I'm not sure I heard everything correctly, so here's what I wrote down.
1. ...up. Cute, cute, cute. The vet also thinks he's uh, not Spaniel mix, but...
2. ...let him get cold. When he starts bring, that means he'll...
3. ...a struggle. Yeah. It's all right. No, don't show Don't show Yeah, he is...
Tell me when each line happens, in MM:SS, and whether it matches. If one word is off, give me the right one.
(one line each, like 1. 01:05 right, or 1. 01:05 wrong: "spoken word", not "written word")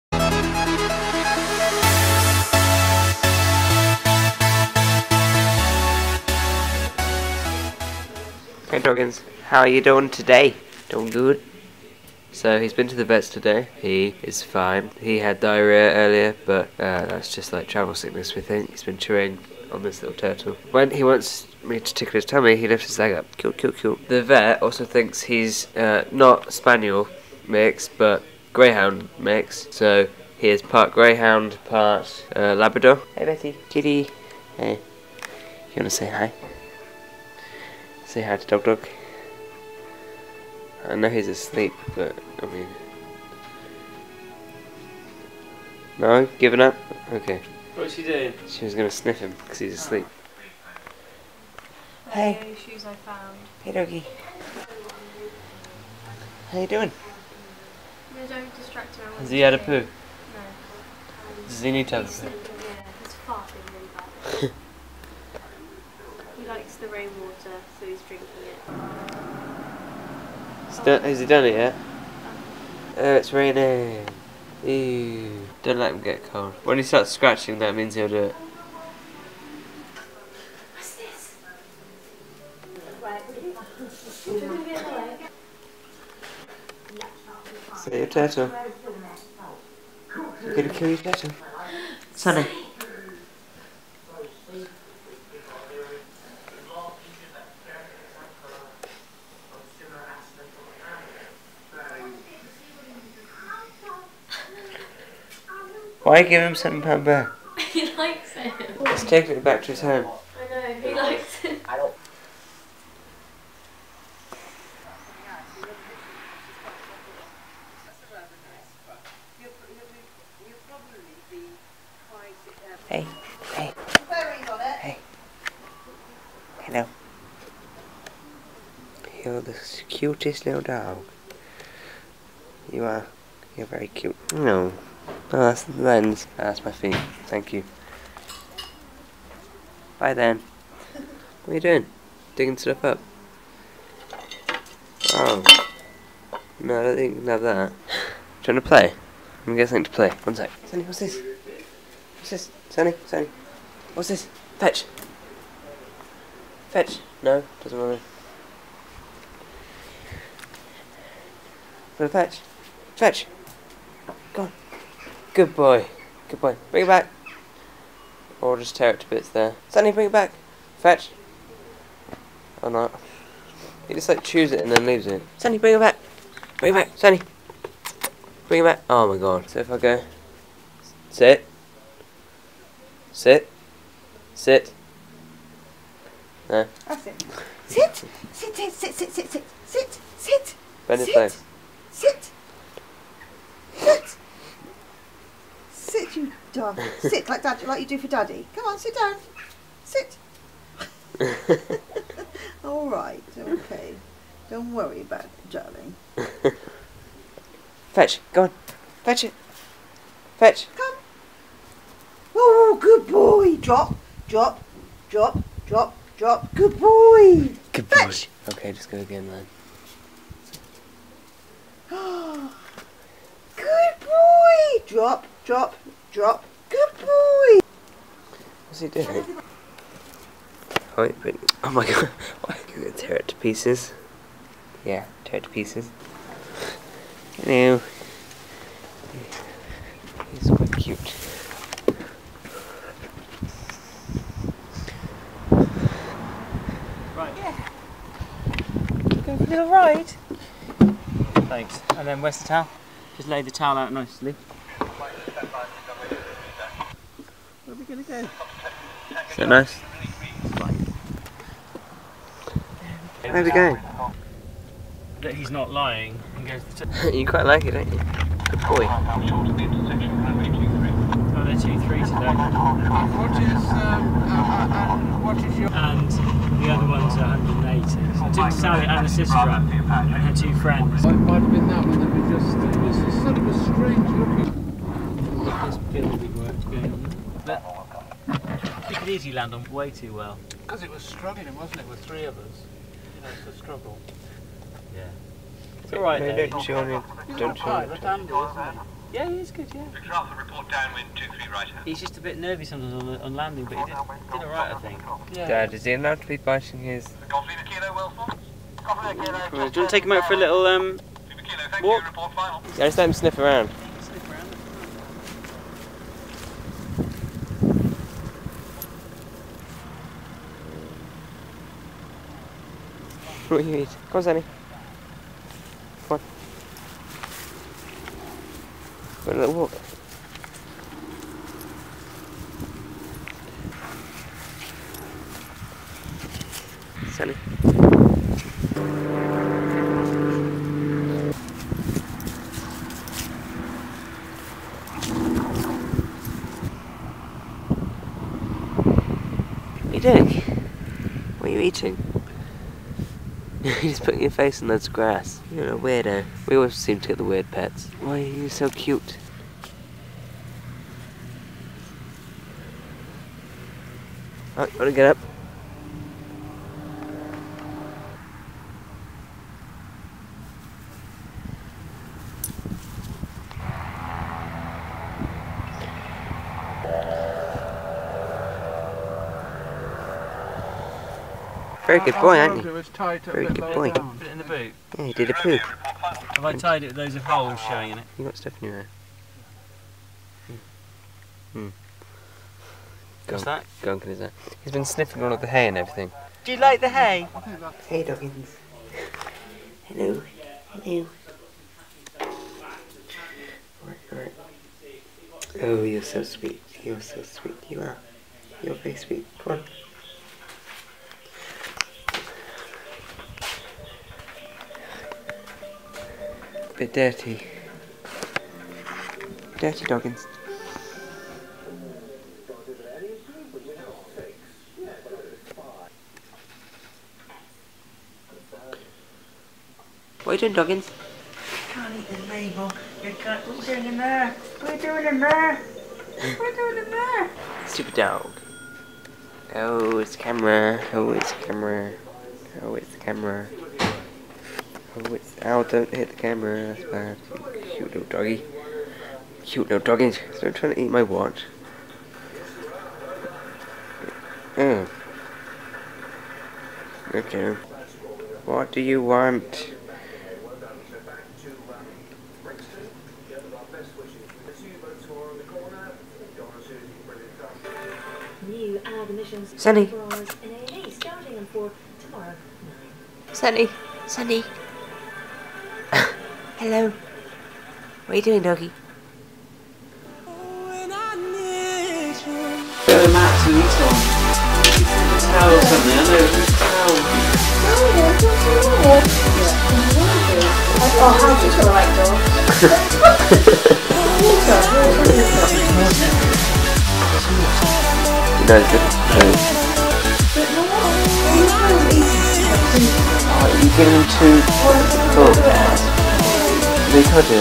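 1. 00:23 right
2. 01:15 wrong: "scratching", not "bring"
3. 04:53 right.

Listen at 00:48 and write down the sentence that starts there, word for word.
She was gonna sniff him because he's asleep.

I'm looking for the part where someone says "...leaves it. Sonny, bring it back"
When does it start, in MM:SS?
02:54.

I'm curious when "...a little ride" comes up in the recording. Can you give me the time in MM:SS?
04:09.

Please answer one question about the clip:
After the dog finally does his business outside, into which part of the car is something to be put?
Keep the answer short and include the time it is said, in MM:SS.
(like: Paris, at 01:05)
the boot, at 06:24.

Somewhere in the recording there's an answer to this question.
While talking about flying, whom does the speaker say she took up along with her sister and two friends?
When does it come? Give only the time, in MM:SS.
04:38.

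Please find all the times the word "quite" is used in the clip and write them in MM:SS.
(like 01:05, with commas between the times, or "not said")
04:00, 04:27.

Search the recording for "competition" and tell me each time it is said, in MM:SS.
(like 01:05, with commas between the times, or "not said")
not said.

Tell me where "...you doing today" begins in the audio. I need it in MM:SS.
00:09.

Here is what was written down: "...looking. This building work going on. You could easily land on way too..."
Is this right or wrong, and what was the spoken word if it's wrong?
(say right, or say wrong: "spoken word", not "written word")
right.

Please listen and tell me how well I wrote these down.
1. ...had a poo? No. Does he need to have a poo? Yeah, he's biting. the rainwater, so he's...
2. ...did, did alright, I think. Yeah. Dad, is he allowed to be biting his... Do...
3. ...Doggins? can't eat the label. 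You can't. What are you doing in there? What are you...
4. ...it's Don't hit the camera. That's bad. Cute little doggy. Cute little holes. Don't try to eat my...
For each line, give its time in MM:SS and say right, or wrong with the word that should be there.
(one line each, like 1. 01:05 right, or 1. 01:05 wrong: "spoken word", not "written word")
1. 00:59 wrong: "farting", not "biting"
2. 05:03 right
3. 07:10 right
4. 07:25 wrong: "doggies", not "holes".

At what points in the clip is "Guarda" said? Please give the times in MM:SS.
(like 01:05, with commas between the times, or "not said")
05:24.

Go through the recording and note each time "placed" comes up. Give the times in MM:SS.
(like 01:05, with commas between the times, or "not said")
not said.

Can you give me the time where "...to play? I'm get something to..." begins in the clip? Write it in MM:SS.
02:28.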